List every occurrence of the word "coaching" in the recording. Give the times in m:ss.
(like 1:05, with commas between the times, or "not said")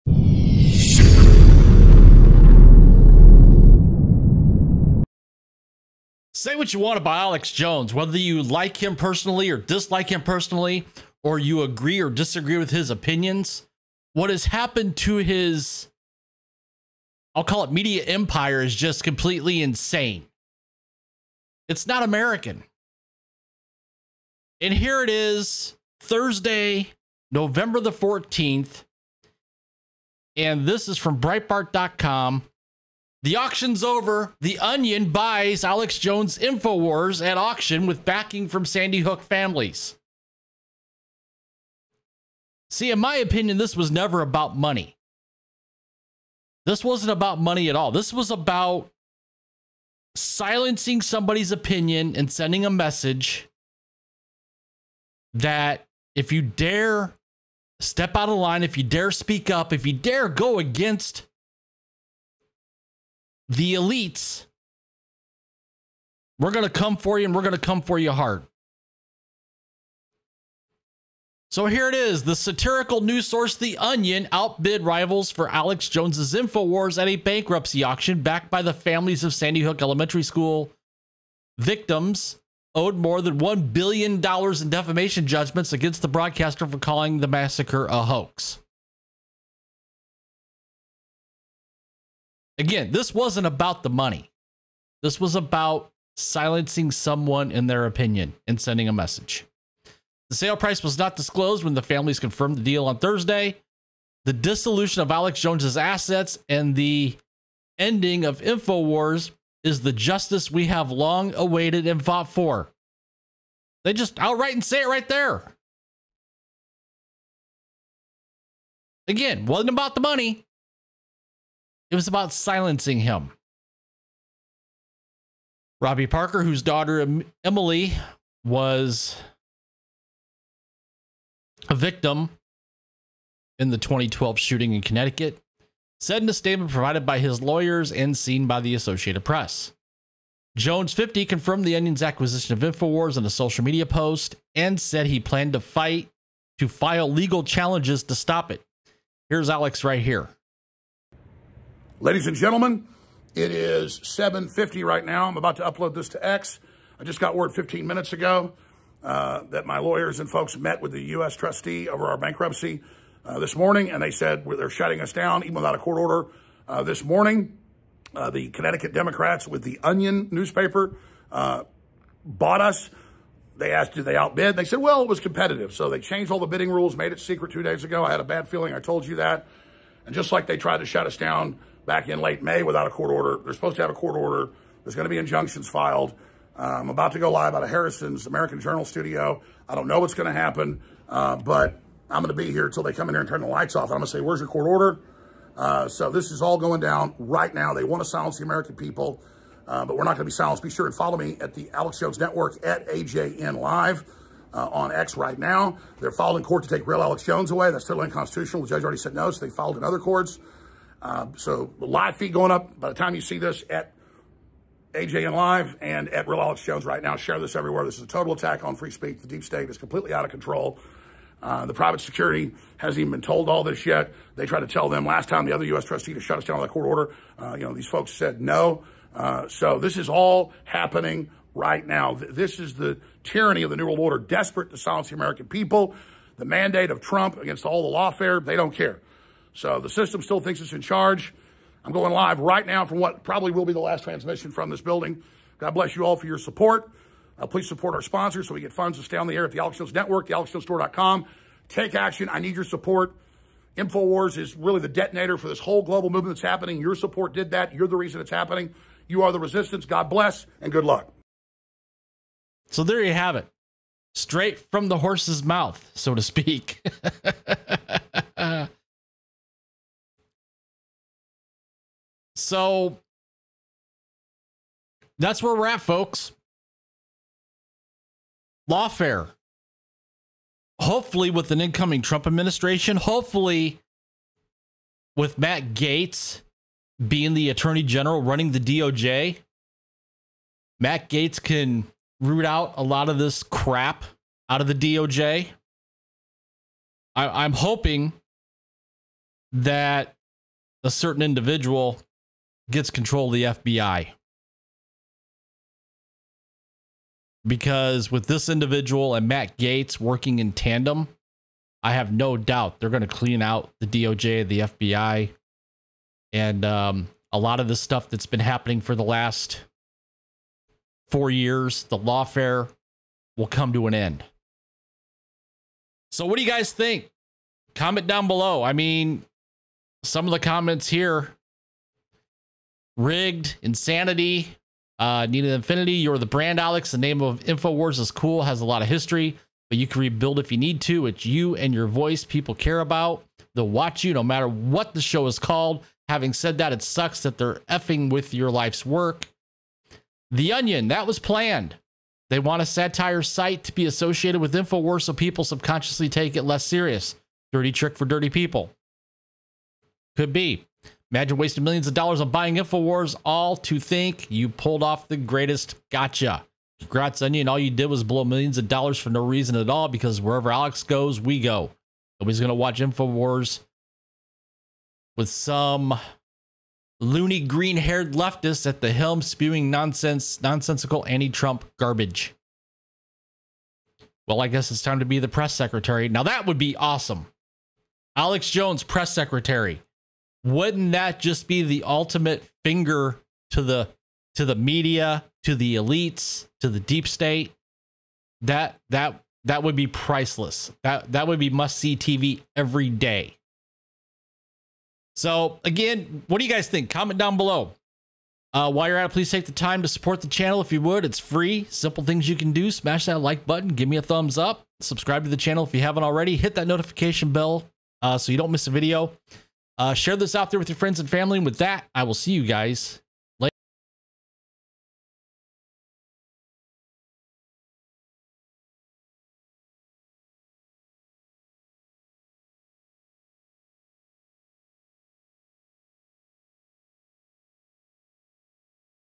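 not said.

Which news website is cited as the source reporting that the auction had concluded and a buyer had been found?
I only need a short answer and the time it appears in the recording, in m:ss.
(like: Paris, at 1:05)
Breitbart.com, at 0:31.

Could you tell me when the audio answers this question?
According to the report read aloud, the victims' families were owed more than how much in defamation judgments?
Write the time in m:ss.
1:23.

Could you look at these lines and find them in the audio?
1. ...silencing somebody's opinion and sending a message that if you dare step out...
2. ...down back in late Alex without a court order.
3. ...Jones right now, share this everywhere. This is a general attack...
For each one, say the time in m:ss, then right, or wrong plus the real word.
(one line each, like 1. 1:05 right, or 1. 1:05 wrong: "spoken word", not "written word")
1. 0:50 right
2. 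3:01 wrong: "May", not "Alex"
3. 3:36 wrong: "total", not "general".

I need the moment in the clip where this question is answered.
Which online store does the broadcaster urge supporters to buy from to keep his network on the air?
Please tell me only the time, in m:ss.
4:10.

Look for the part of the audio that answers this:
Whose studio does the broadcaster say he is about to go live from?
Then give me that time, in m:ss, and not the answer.
3:07.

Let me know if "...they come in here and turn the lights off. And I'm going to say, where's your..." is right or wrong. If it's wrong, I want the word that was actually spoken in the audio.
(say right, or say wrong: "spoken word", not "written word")
right.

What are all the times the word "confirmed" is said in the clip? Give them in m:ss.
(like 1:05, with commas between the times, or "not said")
1:42, 2:21.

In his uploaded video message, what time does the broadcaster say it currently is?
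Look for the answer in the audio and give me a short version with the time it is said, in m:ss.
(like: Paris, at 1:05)
7:50, at 2:33.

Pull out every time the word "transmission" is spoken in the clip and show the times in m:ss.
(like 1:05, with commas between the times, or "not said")
4:04.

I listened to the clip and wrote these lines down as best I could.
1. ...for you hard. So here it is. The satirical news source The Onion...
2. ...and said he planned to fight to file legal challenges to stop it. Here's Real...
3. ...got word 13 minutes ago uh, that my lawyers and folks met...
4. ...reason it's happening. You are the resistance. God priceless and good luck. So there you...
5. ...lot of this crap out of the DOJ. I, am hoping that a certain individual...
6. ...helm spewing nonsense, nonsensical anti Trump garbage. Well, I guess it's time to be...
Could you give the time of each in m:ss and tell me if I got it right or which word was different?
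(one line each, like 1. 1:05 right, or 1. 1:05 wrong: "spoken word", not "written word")
1. 1:07 right
2. 2:24 wrong: "Alex", not "Real"
3. 2:37 wrong: "15", not "13"
4. 4:17 wrong: "bless", not "priceless"
5. 4:52 right
6. 6:18 right.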